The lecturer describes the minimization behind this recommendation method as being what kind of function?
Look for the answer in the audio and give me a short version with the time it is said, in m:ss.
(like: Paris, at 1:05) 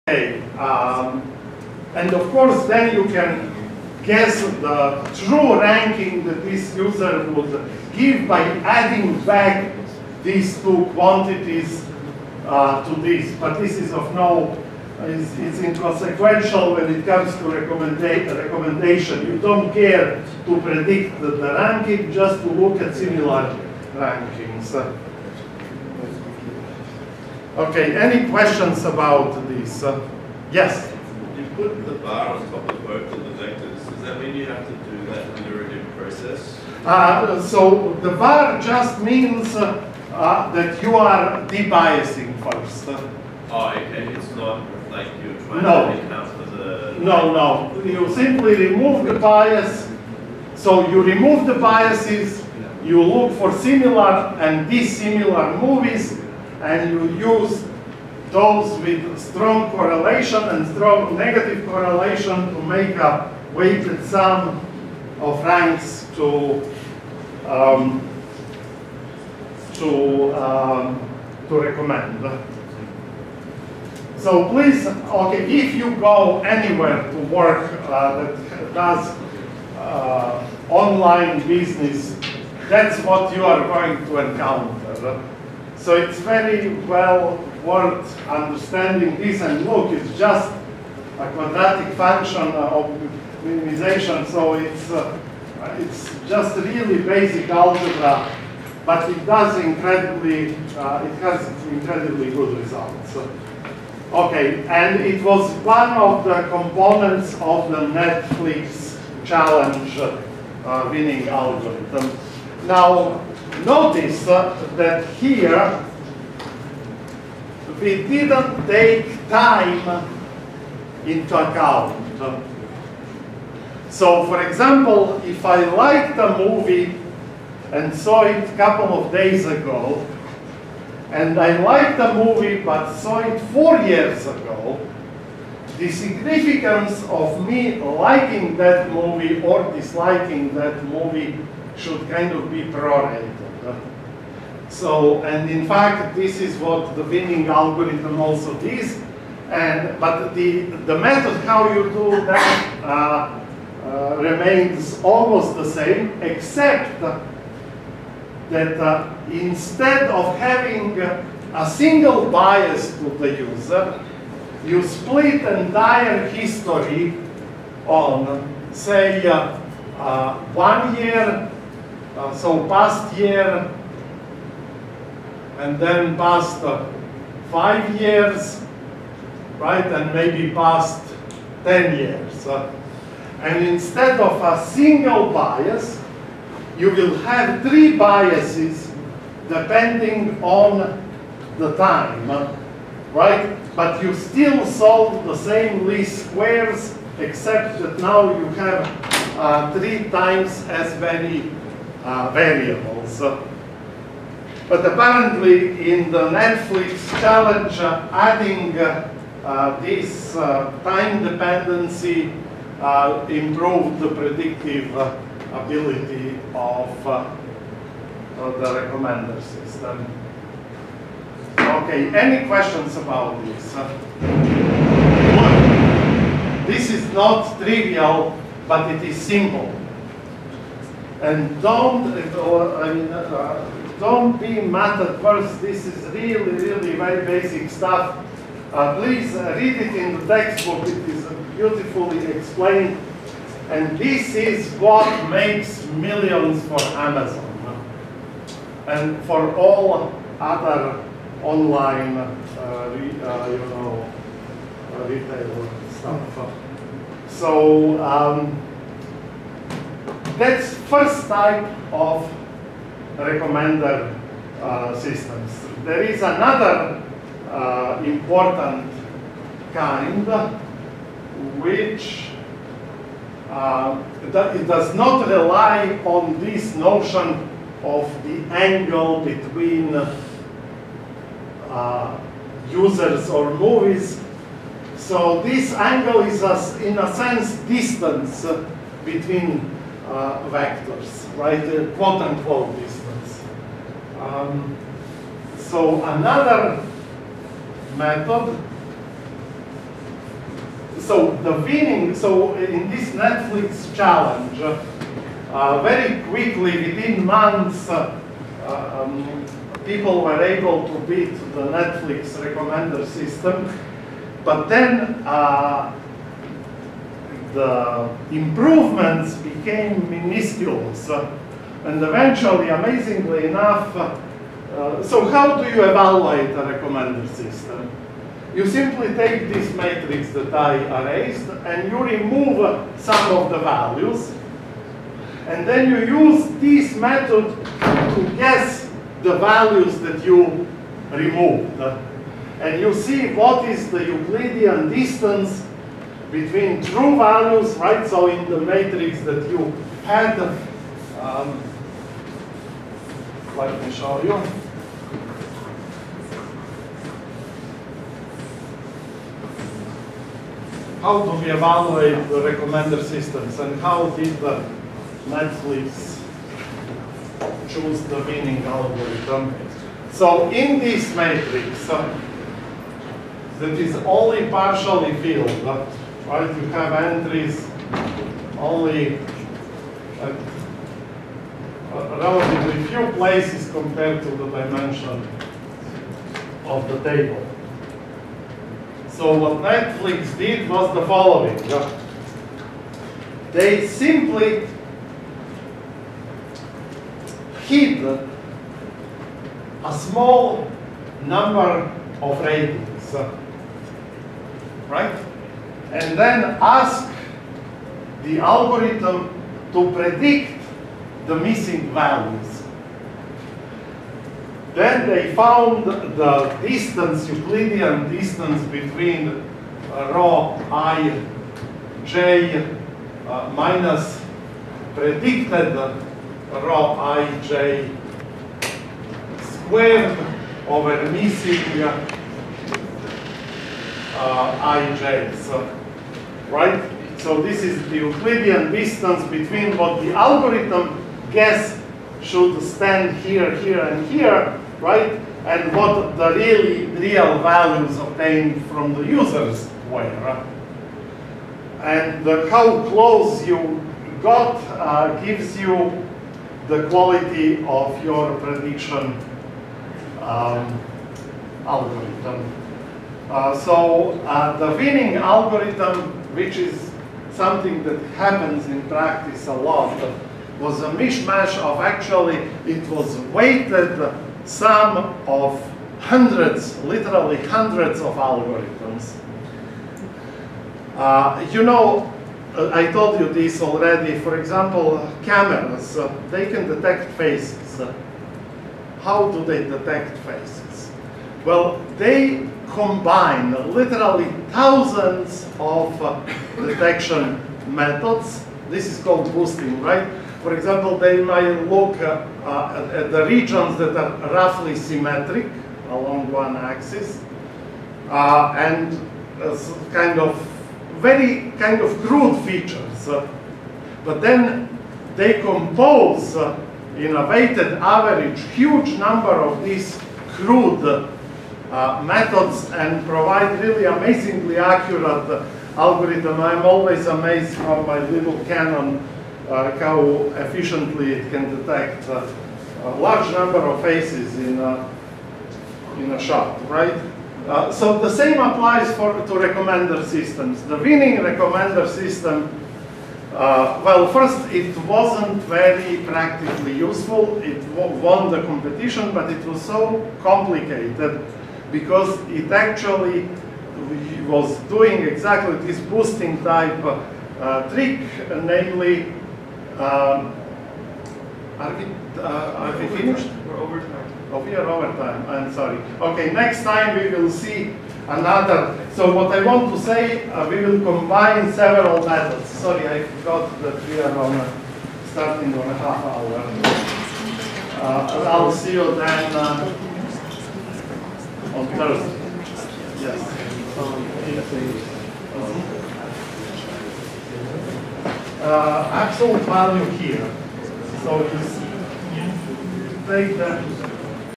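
quadratic, at 1:31.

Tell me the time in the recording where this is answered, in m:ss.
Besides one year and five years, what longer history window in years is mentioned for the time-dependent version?
3:00.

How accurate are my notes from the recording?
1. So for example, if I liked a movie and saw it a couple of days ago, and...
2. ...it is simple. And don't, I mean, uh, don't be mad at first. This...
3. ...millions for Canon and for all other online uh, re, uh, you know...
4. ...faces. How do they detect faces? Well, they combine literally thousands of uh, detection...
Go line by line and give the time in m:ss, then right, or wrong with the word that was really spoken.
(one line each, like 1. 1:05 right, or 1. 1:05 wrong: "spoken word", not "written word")
1. 2:03 right
2. 3:48 right
3. 4:06 wrong: "Amazon", not "Canon"
4. 8:07 right.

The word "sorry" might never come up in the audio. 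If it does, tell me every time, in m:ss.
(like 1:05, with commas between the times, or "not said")
9:25, 9:32.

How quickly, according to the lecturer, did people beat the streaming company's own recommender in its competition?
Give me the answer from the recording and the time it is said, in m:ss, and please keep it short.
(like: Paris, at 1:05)
within months, at 5:06.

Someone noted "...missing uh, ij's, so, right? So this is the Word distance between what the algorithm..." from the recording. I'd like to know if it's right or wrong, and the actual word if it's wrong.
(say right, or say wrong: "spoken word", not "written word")
wrong: "Euclidean", not "Word".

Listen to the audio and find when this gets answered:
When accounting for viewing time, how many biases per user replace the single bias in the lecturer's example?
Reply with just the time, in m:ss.
3:07.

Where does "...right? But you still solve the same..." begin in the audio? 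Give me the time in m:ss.
3:13.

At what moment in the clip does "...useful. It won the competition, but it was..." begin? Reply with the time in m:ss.
9:06.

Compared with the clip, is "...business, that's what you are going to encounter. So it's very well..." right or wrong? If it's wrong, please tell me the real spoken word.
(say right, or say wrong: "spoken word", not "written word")
right.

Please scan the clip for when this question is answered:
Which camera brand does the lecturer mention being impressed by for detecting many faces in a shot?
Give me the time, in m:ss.
8:48.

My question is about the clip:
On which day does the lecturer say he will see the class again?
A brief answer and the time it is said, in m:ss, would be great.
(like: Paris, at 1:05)
Thursday, at 9:41.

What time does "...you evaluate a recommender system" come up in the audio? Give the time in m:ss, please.
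5:25.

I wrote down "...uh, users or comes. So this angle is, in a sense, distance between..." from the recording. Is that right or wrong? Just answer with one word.
wrong.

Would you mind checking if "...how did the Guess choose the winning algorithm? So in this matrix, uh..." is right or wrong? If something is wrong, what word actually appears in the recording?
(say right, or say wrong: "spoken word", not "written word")
wrong: "Netflix", not "Guess".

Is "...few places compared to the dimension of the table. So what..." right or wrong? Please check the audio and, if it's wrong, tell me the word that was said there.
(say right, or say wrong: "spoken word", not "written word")
right.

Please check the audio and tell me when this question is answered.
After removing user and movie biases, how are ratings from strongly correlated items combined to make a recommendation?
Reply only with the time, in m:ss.
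1:03.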